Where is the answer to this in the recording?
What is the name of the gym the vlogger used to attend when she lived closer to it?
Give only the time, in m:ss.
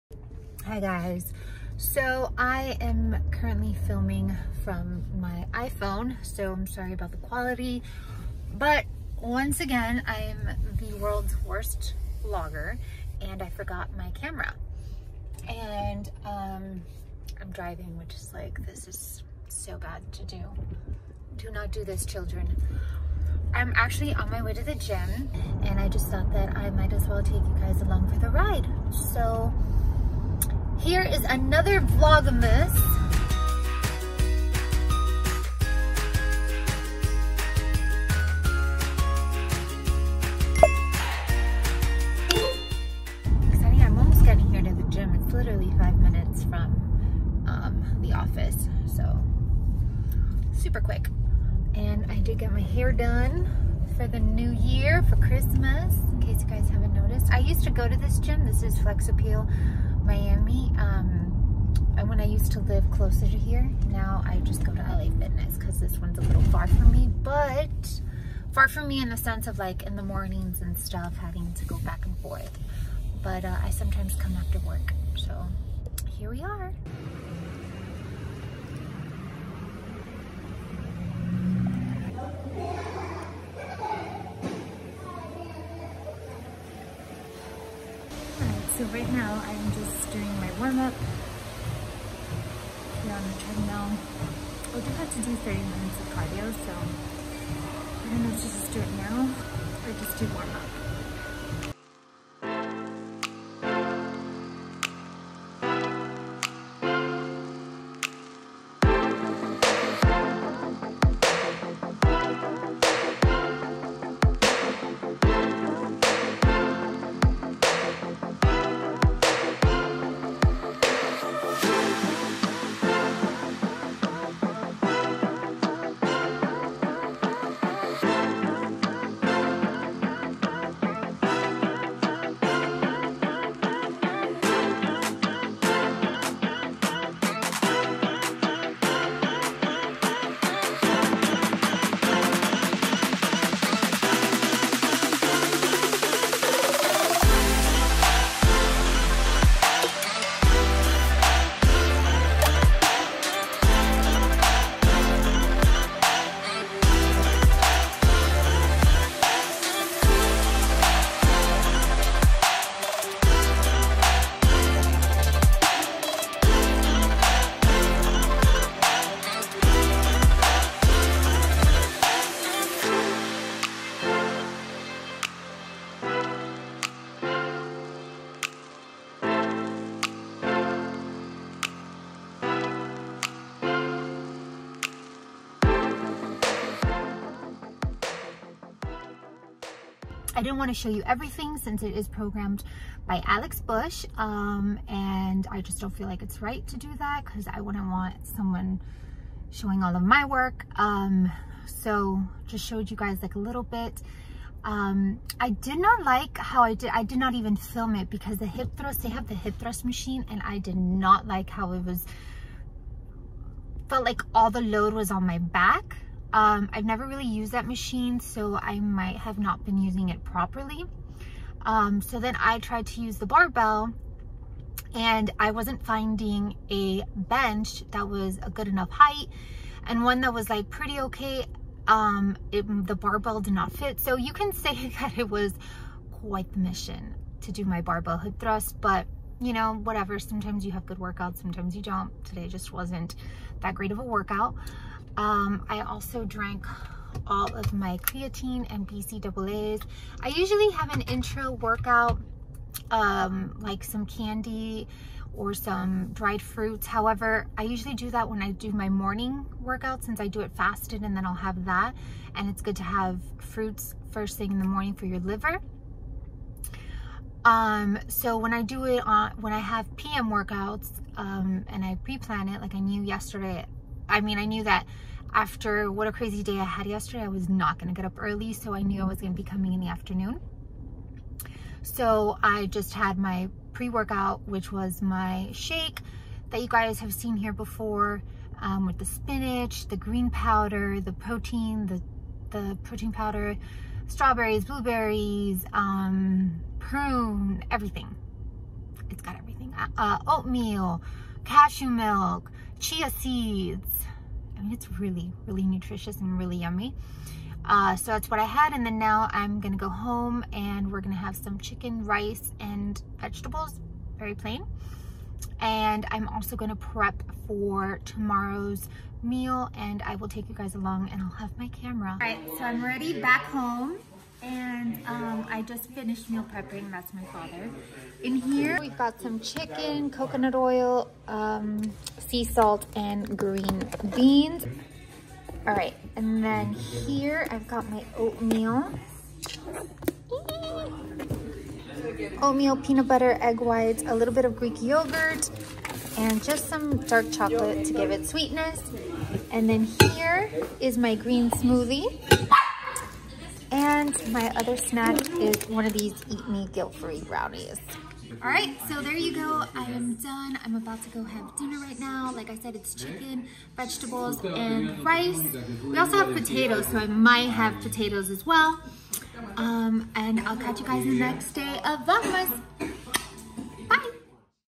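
0:58.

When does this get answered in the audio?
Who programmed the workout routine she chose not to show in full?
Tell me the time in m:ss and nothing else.
3:13.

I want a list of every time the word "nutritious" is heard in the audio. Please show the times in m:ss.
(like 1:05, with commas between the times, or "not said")
5:05.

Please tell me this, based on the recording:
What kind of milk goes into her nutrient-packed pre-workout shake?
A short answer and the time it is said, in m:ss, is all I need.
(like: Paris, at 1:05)
Cashew milk, at 5:01.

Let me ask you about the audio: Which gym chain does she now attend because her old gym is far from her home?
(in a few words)
LA Fitness.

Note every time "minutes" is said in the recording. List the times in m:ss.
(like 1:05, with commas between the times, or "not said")
0:45, 1:35.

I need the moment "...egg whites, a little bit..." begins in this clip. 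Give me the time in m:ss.
5:43.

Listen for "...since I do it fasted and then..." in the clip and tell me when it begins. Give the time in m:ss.
4:20.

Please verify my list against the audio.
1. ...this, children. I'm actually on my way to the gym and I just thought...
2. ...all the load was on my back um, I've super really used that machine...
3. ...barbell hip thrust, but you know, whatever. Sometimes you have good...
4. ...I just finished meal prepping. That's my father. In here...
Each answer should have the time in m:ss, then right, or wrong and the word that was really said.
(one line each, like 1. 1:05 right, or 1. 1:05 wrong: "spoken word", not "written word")
1. 0:21 right
2. 3:34 wrong: "never", not "super"
3. 3:57 right
4. 5:25 right.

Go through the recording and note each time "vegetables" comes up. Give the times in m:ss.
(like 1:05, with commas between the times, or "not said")
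5:13, 6:03.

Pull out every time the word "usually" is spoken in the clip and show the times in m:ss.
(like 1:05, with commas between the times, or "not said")
4:10, 4:17.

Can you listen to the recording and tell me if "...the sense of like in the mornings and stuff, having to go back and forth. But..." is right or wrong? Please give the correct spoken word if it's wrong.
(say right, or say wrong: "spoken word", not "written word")
right.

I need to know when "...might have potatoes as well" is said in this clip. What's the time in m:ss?
6:07.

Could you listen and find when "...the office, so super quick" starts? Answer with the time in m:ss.
0:48.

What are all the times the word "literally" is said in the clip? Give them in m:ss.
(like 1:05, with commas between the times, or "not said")
0:45.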